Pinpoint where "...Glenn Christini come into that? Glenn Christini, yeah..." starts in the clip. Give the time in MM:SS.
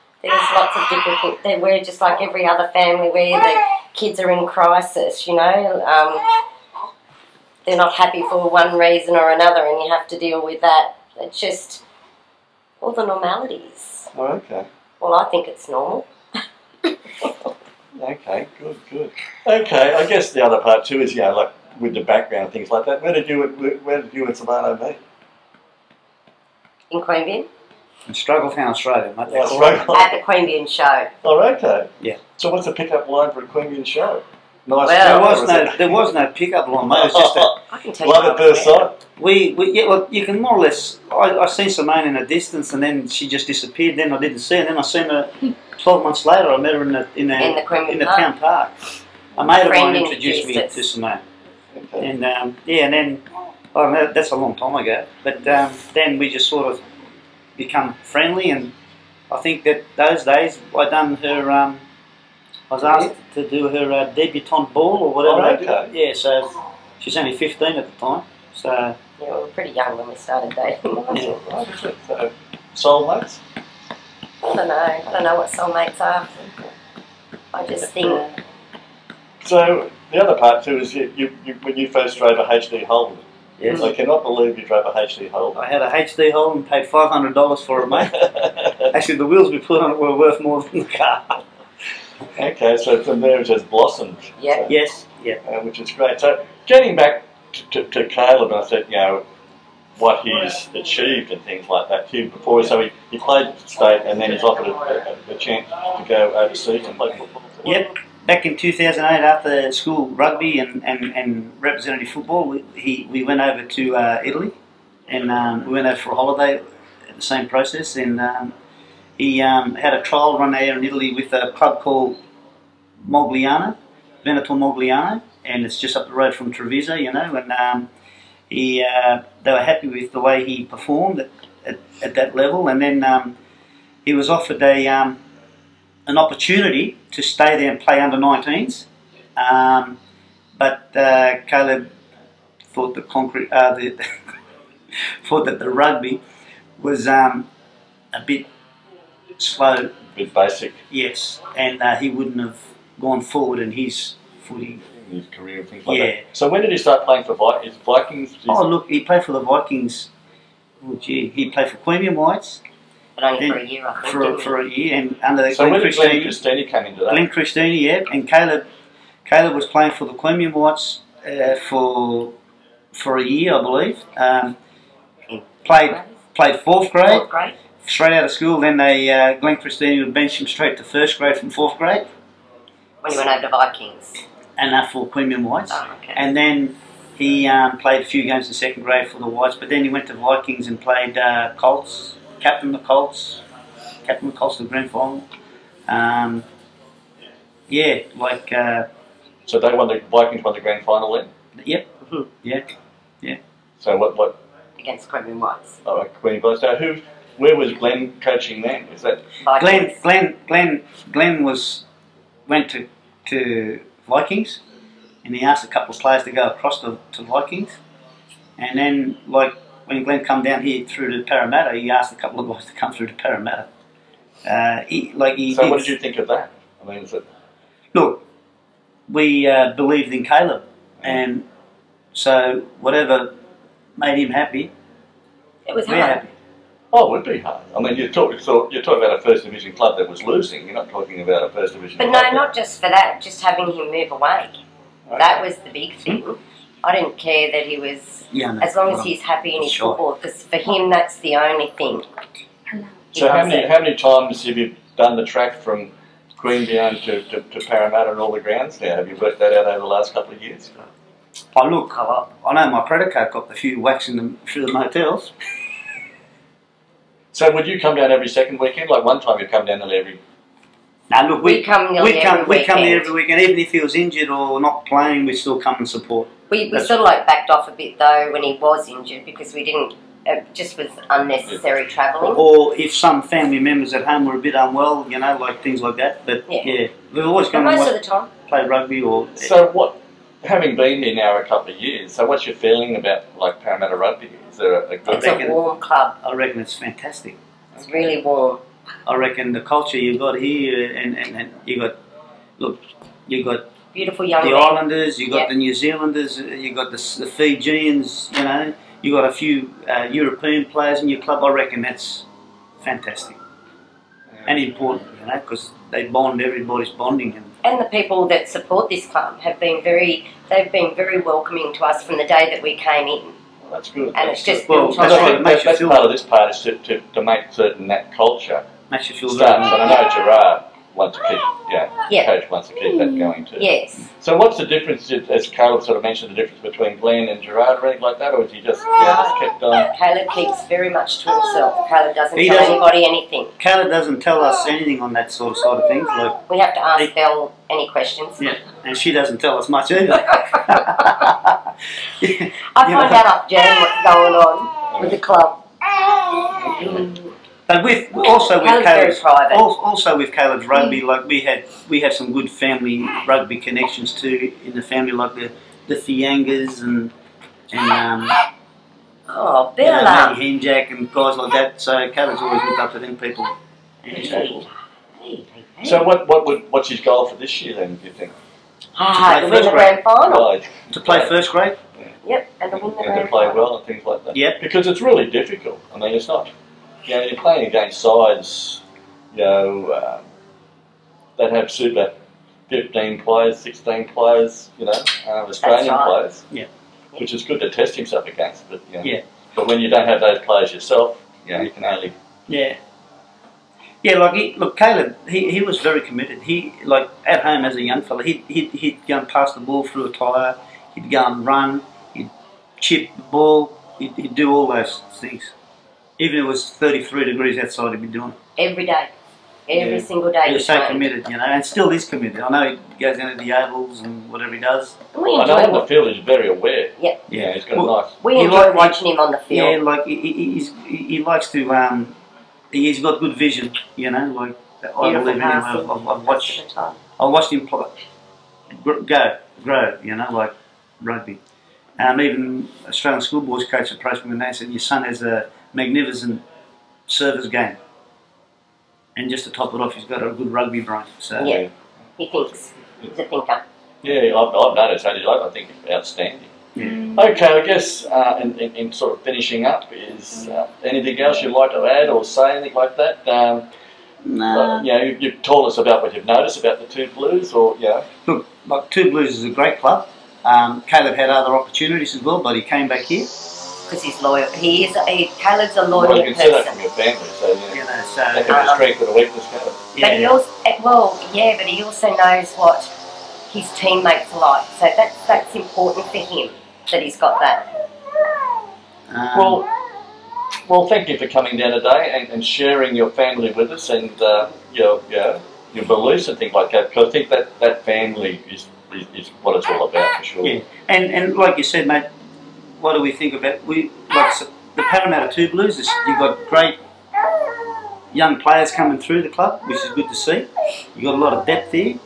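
02:45.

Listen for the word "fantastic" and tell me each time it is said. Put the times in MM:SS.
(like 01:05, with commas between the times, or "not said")
04:56, 05:12.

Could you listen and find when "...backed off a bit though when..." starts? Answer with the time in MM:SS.
04:37.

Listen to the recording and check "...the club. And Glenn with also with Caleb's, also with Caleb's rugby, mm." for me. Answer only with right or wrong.
wrong.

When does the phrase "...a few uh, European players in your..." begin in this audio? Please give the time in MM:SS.
05:09.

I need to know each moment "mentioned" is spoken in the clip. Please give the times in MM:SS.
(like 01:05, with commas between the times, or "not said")
05:36.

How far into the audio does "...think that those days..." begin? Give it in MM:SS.
00:59.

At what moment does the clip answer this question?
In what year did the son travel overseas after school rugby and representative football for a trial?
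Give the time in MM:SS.
01:48.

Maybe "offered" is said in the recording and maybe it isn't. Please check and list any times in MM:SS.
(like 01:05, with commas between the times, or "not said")
01:44, 02:14.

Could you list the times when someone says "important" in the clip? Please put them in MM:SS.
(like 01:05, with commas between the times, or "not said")
05:14, 08:05.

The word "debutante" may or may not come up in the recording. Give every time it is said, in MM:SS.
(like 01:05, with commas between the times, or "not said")
01:04.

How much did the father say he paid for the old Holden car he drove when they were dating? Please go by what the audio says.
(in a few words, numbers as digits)
$500.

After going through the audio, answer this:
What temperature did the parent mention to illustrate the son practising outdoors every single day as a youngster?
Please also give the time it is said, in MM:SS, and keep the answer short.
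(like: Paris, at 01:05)
33 degrees, at 06:56.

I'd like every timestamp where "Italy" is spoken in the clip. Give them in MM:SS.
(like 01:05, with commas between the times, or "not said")
01:54, 02:00.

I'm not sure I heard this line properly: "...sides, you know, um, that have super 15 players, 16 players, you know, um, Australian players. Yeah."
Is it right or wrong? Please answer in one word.
right.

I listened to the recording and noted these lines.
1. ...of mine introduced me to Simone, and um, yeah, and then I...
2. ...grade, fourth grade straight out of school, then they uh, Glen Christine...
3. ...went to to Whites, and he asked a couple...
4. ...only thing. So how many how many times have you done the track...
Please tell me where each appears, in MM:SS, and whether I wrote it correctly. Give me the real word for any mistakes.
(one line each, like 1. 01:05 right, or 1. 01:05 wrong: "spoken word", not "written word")
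1. 00:49 right
2. 02:56 right
3. 03:32 wrong: "Vikings", not "Whites"
4. 04:11 right.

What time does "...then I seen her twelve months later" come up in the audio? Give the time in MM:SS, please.
00:44.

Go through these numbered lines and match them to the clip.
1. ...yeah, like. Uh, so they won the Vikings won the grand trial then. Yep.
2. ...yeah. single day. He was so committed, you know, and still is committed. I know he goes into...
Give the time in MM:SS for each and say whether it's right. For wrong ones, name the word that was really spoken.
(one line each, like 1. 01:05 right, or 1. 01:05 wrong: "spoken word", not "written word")
1. 03:17 wrong: "final", not "trial"
2. 06:59 right.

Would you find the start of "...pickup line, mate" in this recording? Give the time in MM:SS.
00:36.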